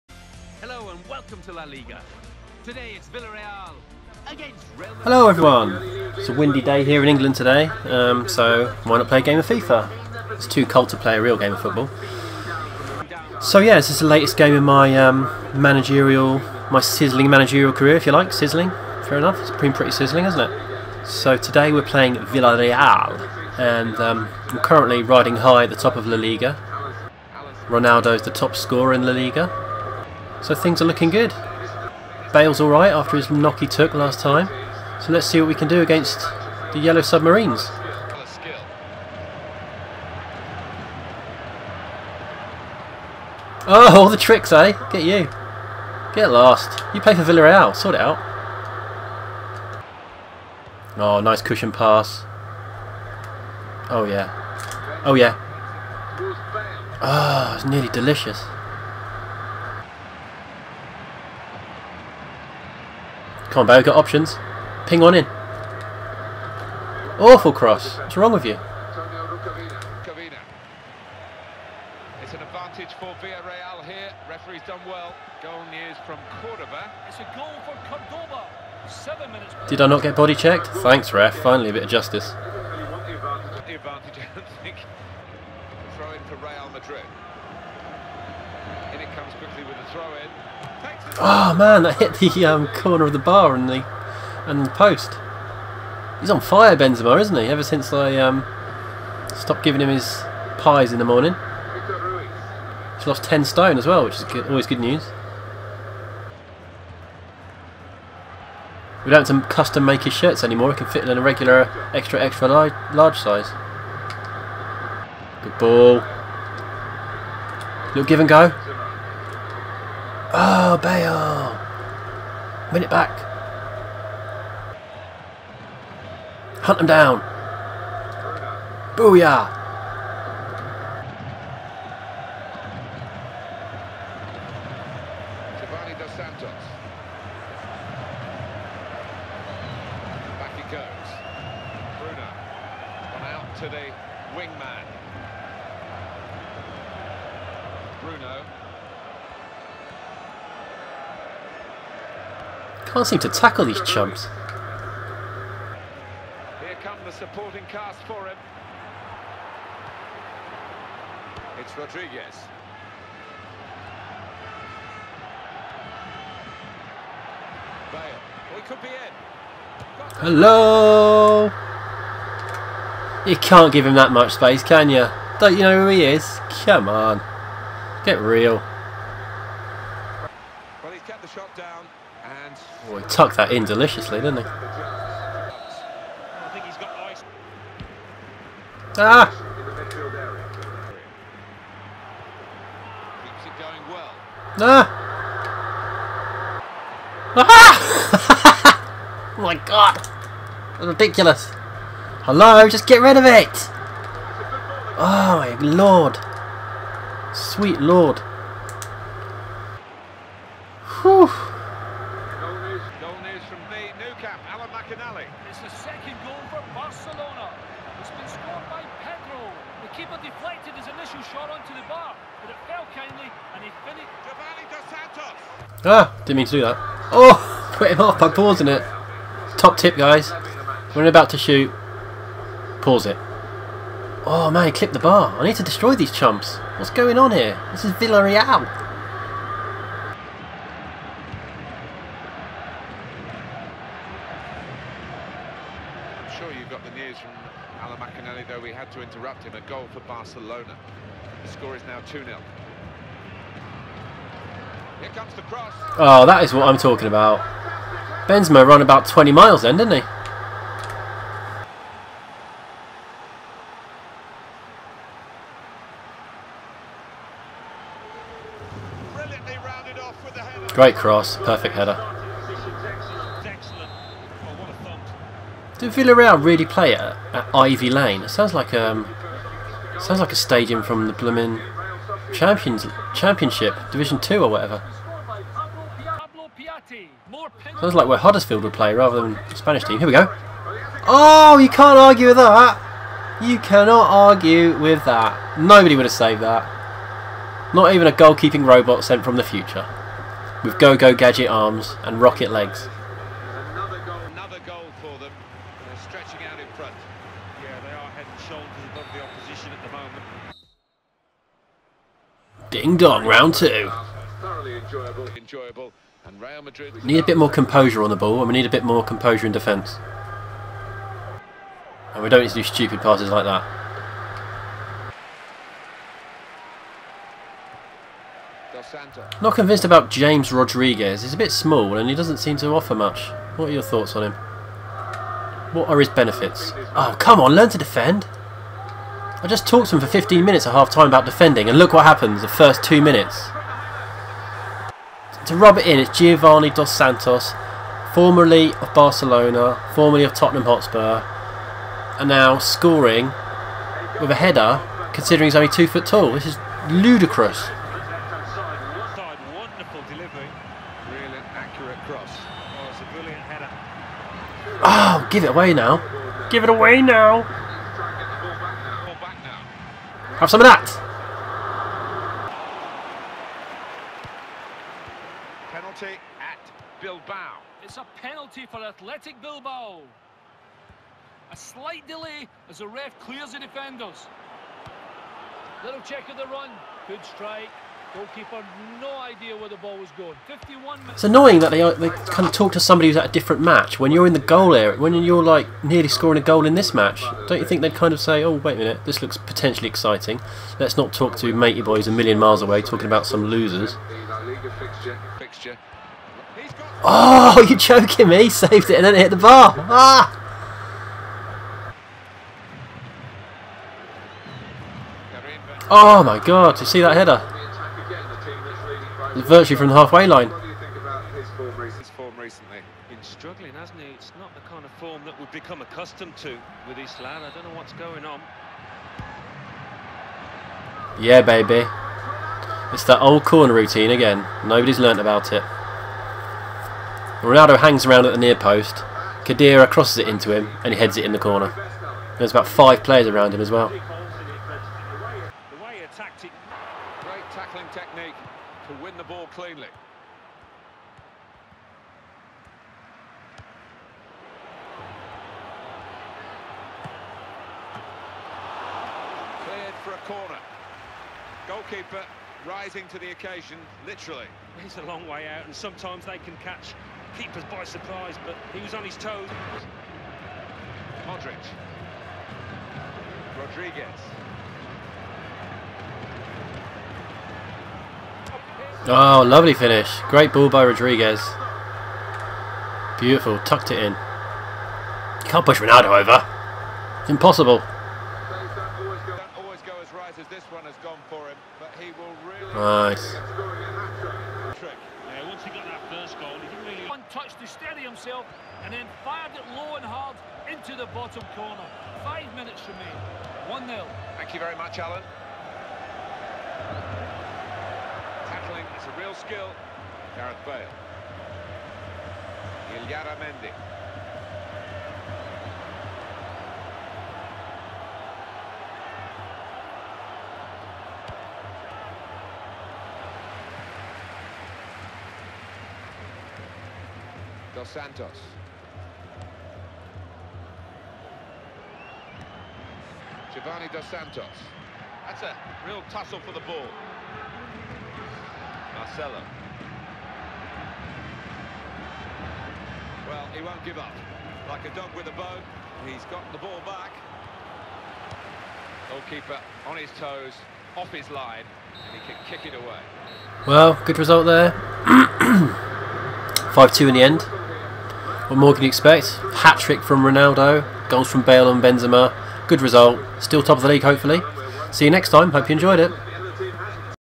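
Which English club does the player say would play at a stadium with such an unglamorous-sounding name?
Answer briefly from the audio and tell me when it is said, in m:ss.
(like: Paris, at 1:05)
Huddersfield, at 4:48.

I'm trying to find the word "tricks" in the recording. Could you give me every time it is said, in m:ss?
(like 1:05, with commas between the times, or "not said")
0:44, 9:19.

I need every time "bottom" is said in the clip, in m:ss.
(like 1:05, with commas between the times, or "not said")
8:21.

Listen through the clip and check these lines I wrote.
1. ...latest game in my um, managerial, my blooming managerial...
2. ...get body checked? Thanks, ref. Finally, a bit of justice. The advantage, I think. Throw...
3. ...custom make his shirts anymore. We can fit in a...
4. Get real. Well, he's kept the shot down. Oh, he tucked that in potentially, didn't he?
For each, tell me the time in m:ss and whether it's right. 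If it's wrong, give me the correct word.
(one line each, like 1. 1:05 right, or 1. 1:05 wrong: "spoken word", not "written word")
1. 0:14 wrong: "sizzling", not "blooming"
2. 1:20 right
3. 1:49 right
4. 2:58 wrong: "deliciously", not "potentially".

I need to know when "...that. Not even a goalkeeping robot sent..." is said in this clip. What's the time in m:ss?
4:56.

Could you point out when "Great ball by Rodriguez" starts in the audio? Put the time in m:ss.
8:00.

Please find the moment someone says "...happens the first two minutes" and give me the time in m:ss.
5:42.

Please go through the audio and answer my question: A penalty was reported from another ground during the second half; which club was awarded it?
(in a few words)
Athletic Bilbao.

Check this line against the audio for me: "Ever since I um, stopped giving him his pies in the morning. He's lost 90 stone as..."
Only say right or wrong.
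wrong.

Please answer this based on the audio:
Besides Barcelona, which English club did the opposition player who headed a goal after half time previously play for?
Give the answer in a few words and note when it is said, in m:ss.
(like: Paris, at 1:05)
Tottenham Hotspur, at 5:50.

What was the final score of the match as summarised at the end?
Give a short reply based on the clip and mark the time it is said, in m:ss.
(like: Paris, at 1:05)
5-2, at 9:16.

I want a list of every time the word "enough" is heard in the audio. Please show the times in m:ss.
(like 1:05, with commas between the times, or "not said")
0:19.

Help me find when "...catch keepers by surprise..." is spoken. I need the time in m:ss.
7:46.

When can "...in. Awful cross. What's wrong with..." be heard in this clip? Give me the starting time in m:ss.
1:05.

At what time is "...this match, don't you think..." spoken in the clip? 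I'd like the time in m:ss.
6:36.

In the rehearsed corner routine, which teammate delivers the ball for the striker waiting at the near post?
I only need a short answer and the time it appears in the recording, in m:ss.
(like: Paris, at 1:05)
Khedira, at 7:19.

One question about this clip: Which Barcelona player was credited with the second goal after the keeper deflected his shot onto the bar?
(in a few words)
Pedro.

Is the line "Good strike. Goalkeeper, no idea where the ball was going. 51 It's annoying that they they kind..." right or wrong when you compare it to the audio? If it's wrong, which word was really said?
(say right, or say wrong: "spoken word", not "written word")
right.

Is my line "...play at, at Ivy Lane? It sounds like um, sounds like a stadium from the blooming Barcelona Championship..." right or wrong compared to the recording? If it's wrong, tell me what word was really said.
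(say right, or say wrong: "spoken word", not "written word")
wrong: "Champions", not "Barcelona".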